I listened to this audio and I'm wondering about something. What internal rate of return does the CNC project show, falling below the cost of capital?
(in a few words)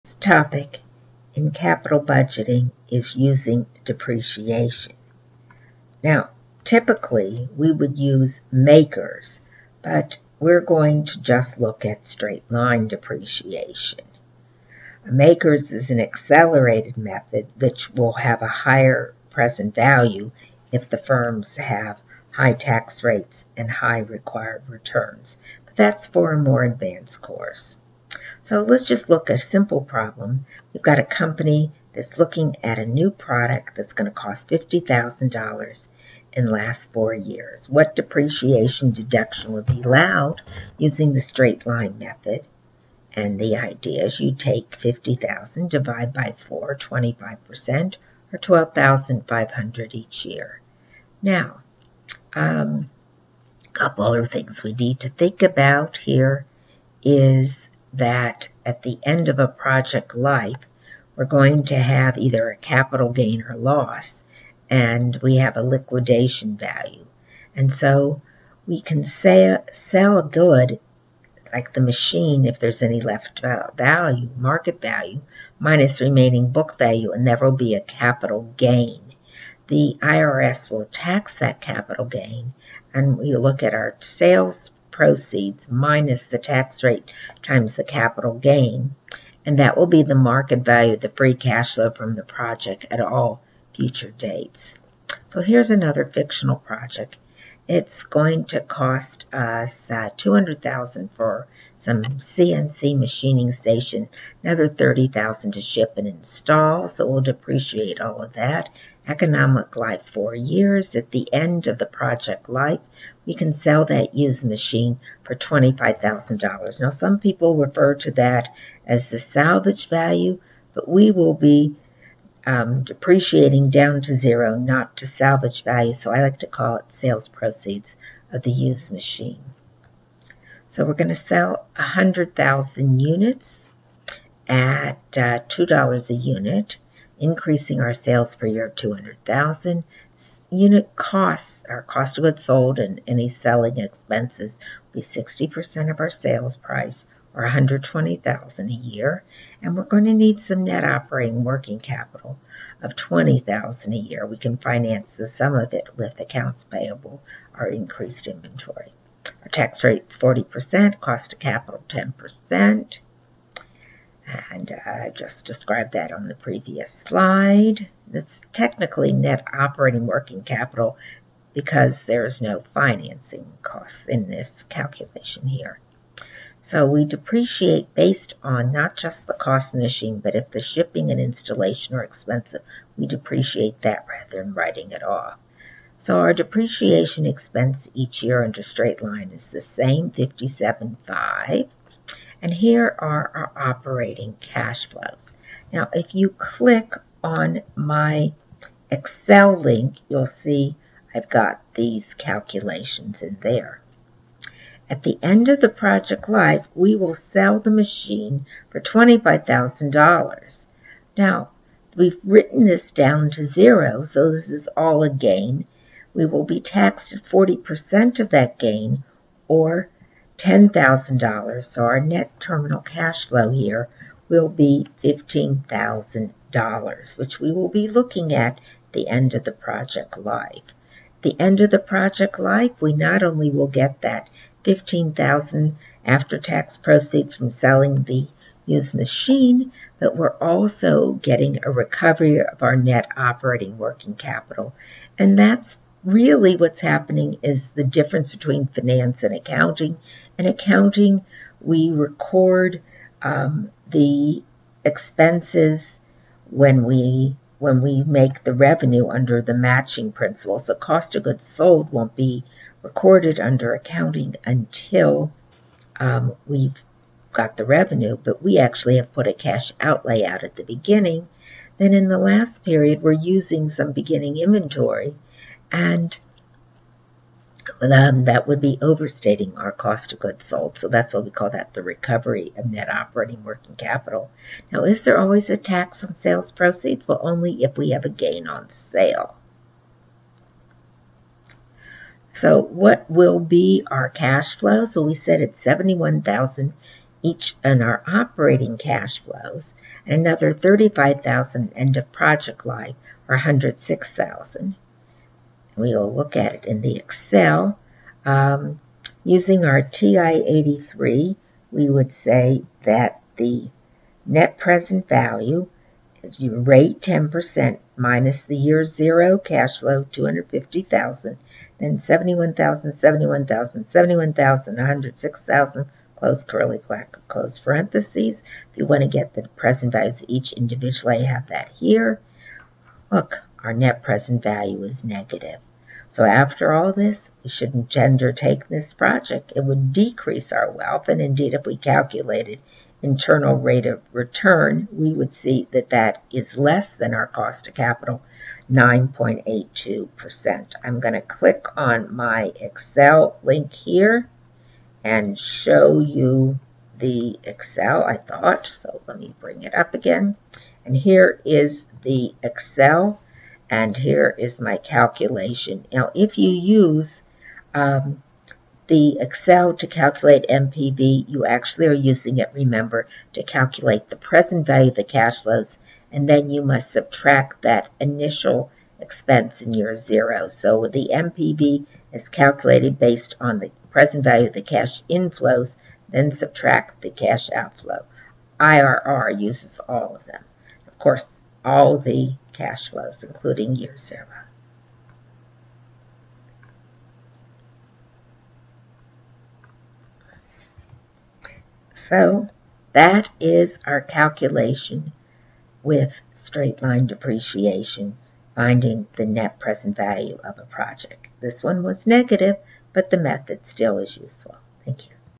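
9.82%.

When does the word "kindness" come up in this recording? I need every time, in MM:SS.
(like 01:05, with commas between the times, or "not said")
not said.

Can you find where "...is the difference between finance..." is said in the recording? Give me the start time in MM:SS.
04:07.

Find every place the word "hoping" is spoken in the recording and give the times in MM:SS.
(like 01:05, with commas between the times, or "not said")
not said.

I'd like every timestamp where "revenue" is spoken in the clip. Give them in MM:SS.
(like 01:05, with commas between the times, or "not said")
04:18, 04:27.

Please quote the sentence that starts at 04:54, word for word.
So we said it's 71,000 each in our operating cash flows and another 35,000 end of project life or 106,000.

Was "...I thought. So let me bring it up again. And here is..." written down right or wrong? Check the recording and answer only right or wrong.
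right.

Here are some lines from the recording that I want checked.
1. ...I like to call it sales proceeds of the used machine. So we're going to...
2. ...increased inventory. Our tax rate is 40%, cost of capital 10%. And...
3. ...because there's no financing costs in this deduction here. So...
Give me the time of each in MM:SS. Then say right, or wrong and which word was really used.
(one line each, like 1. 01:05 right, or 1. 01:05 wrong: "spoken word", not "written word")
1. 02:06 right
2. 02:37 right
3. 02:51 wrong: "calculation", not "deduction".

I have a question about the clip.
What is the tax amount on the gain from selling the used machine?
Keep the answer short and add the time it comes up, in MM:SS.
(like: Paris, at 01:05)
$10,000, at 03:40.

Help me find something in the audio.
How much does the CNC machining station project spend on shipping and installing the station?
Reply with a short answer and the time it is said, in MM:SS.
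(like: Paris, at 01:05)
30,000, at 01:44.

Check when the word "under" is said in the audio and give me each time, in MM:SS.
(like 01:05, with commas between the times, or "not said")
03:08, 04:19, 04:23.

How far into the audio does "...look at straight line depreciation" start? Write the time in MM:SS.
00:11.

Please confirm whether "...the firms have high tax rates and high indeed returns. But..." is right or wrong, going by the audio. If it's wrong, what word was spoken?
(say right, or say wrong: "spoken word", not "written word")
wrong: "required", not "indeed".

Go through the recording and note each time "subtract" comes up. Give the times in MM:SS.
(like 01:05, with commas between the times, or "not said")
06:16, 06:26.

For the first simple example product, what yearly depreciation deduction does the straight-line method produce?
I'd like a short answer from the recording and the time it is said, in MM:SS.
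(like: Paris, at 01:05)
12,500, at 00:48.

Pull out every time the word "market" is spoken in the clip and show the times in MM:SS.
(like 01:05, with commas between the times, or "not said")
01:14, 01:30.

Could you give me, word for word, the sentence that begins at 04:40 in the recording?
So that's why we call that the recovery of net operating working capital.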